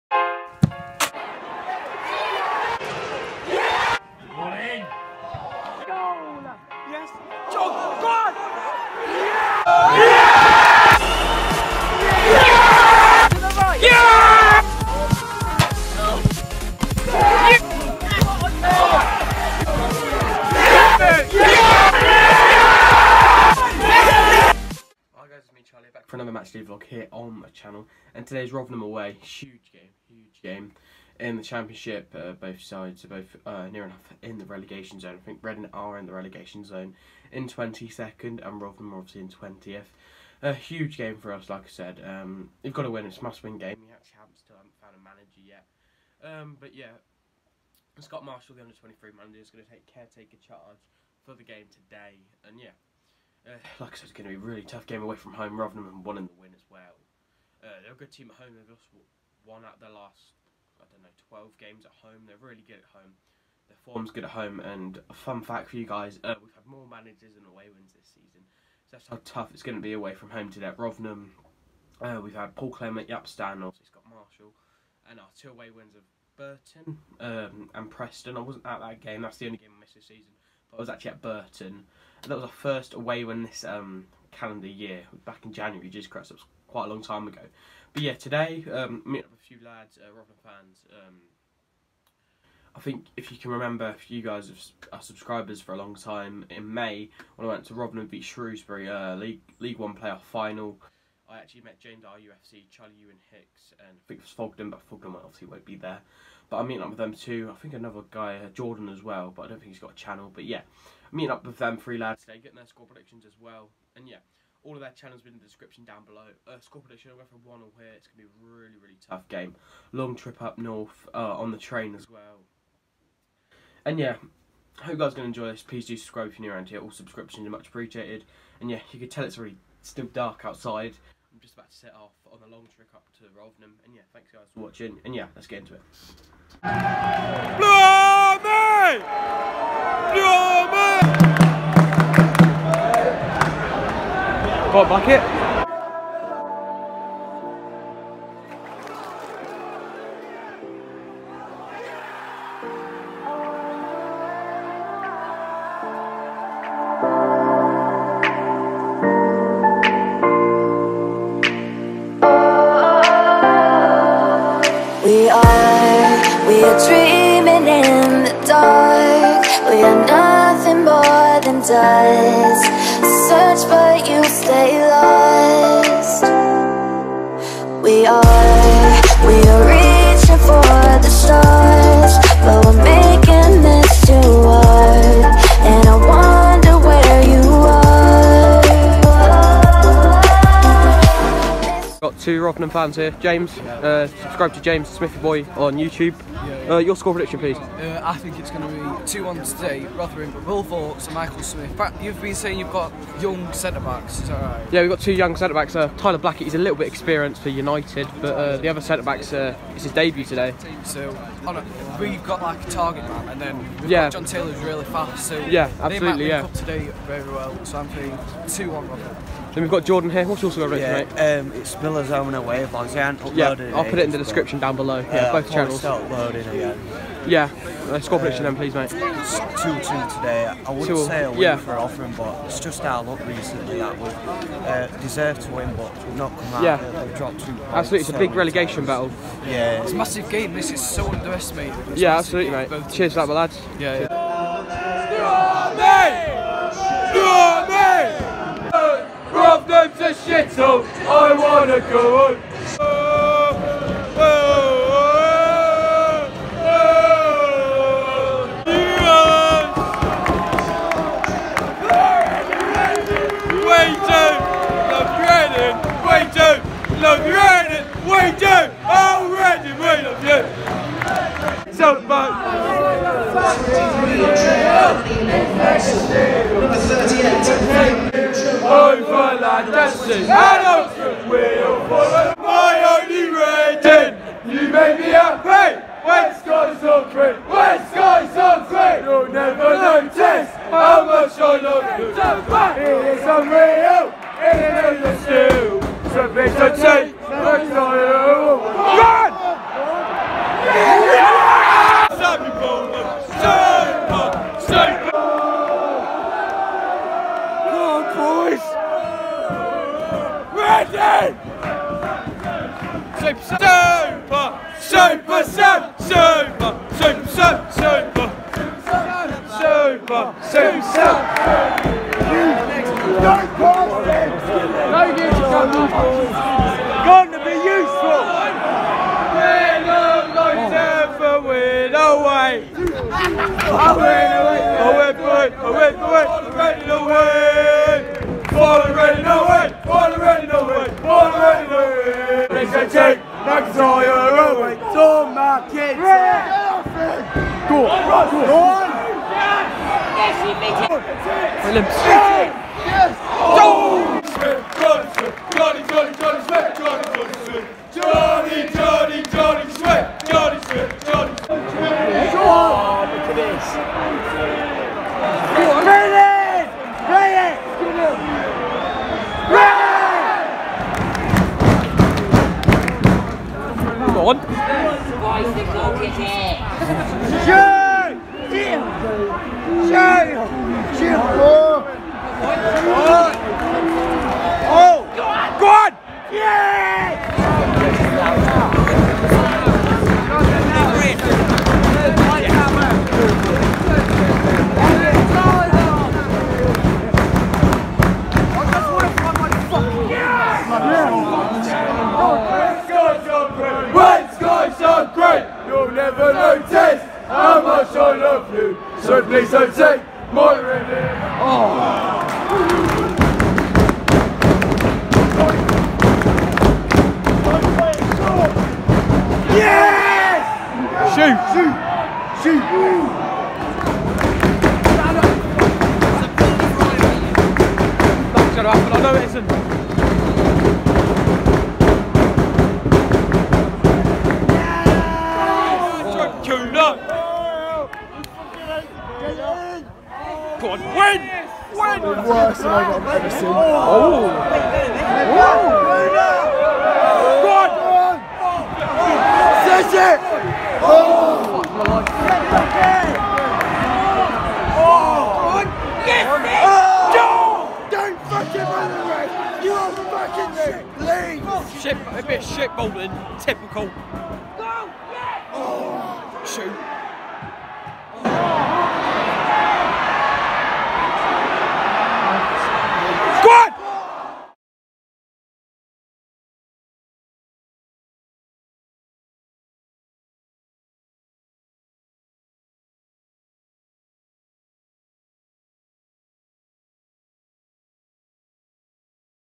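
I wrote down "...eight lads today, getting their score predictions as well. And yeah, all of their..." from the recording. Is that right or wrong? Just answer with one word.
wrong.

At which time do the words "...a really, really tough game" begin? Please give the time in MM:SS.
01:58.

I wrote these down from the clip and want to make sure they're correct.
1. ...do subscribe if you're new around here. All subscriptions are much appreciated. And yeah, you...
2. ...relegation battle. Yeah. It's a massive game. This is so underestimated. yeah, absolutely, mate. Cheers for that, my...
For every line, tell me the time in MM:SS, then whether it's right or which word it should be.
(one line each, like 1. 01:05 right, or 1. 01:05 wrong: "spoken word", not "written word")
1. 02:05 right
2. 03:58 right.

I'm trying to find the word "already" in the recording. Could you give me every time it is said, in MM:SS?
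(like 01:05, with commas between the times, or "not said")
03:40.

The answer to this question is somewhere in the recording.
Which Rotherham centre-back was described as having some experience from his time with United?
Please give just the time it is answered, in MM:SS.
03:25.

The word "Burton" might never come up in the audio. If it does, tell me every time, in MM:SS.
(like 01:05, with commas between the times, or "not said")
01:16, 01:21.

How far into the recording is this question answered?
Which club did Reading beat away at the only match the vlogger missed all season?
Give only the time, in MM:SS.
01:17.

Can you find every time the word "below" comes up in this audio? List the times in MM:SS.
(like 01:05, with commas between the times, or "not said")
01:56, 03:44.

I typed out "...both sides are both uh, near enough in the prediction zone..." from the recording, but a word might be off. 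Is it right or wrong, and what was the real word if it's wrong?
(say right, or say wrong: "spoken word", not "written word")
wrong: "relegation", not "prediction".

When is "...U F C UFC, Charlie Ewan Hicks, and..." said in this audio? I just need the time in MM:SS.
01:42.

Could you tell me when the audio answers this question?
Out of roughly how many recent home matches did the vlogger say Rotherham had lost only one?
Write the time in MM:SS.
01:01.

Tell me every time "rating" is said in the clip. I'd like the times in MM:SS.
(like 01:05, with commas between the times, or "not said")
04:43.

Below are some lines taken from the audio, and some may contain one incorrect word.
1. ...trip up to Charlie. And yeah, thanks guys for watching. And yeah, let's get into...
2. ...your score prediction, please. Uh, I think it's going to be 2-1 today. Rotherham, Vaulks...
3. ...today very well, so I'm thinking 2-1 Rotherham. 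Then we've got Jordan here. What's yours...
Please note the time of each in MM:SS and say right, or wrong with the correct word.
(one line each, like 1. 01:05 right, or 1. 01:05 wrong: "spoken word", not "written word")
1. 02:12 wrong: "Rotherham", not "Charlie"
2. 03:16 wrong: "Will", not "Vaulks"
3. 03:36 right.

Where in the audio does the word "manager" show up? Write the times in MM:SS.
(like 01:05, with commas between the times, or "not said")
00:45, 00:49, 01:06.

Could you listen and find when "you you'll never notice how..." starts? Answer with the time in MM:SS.
04:49.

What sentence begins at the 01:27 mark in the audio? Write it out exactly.
But yeah, today, um, meet up with a few lads, uh, fans.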